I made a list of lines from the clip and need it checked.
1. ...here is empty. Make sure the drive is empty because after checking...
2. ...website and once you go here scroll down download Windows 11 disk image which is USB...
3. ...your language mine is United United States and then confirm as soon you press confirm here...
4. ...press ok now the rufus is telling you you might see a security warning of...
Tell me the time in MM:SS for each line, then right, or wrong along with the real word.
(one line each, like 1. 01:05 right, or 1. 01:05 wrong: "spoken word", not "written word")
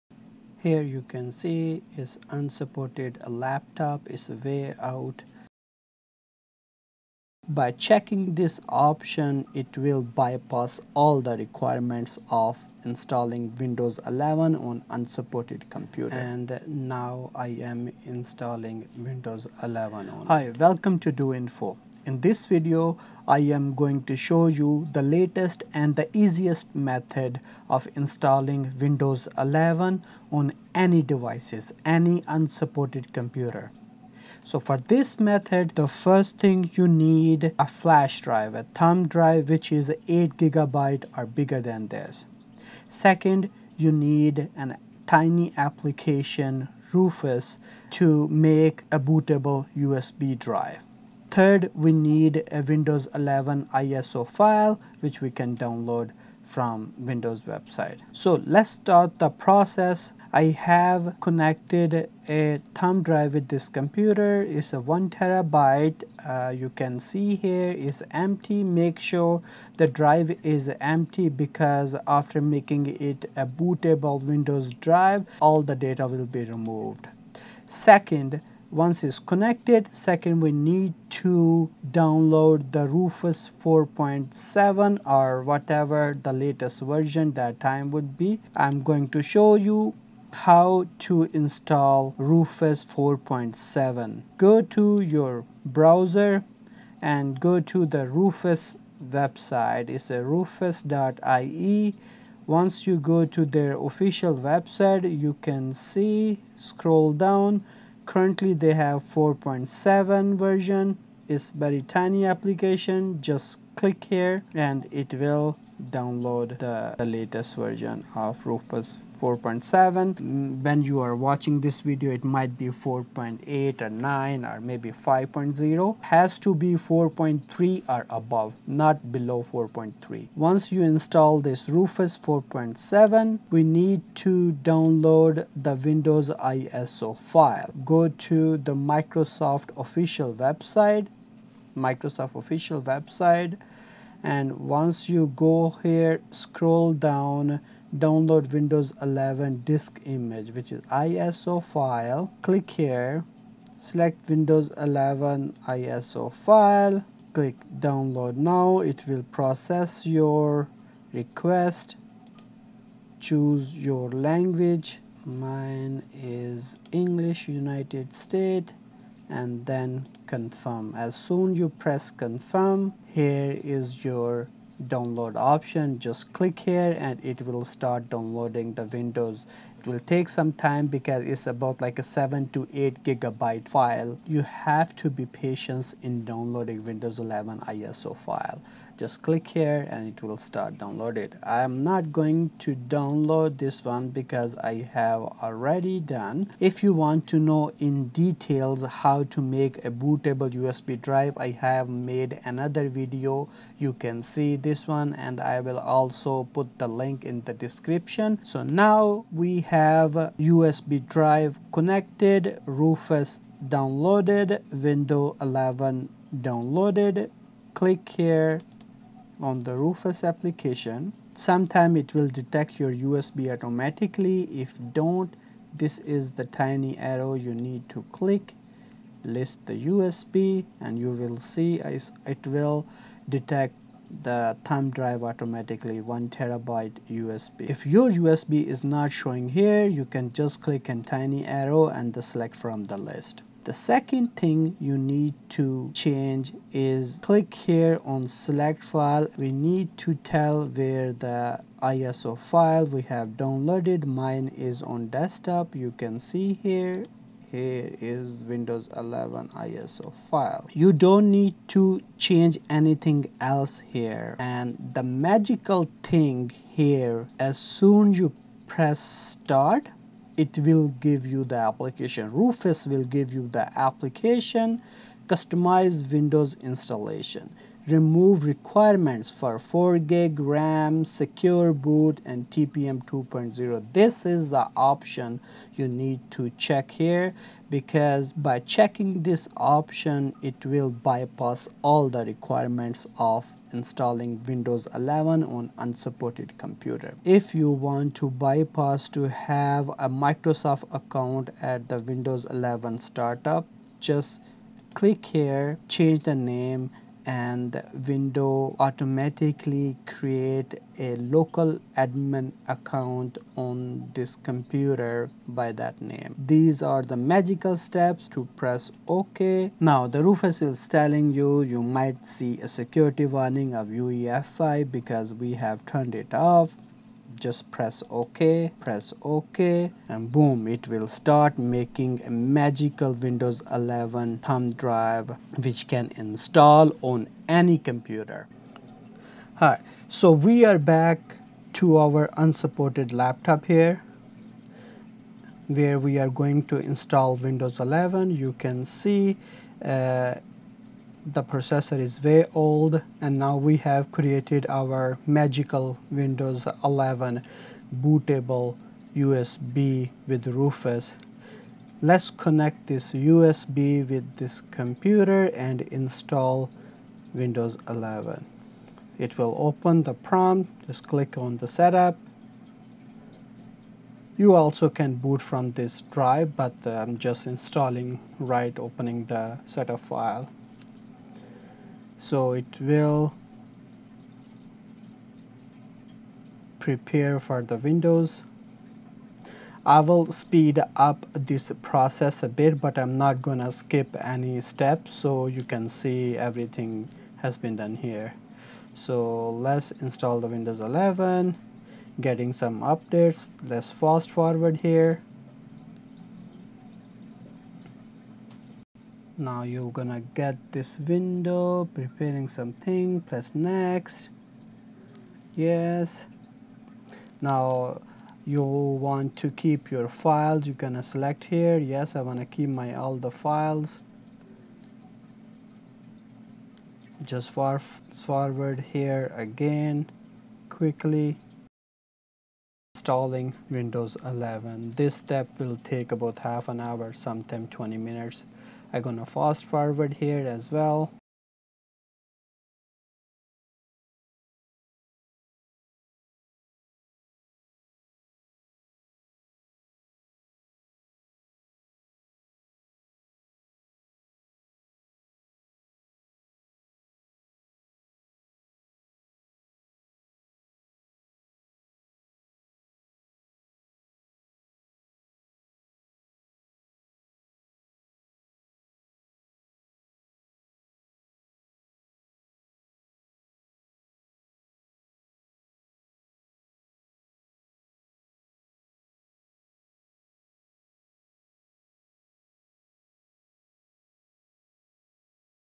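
1. 01:07 wrong: "making", not "checking"
2. 02:22 wrong: "ISO", not "USB"
3. 02:43 wrong: "English", not "United"
4. 05:18 right.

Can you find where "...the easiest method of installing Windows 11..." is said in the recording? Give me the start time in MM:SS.
00:25.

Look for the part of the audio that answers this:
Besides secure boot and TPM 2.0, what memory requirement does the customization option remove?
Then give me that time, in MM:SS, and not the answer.
04:39.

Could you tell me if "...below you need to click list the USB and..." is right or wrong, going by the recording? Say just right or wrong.
wrong.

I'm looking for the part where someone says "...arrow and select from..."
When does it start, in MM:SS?
04:01.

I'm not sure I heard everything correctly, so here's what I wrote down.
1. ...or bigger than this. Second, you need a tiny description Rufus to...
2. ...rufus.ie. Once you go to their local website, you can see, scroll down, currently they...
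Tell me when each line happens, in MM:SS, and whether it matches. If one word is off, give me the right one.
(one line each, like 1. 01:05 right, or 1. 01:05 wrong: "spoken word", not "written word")
1. 00:41 wrong: "application", not "description"
2. 01:40 wrong: "official", not "local".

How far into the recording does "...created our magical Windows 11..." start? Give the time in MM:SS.
05:54.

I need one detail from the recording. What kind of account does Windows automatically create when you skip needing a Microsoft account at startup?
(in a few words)
local admin account.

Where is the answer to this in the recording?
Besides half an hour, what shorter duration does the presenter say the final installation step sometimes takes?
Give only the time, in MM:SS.
07:17.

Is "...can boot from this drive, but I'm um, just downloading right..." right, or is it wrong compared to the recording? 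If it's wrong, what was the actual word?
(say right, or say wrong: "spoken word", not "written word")
wrong: "installing", not "downloading".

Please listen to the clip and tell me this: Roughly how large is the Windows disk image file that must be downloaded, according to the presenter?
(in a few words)
7 to 8 gigabyte.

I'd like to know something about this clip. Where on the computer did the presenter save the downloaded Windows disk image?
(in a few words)
desktop.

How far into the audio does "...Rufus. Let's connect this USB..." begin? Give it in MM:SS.
06:00.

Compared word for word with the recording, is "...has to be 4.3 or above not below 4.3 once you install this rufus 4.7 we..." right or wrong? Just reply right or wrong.
right.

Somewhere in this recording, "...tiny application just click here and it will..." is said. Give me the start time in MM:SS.
01:51.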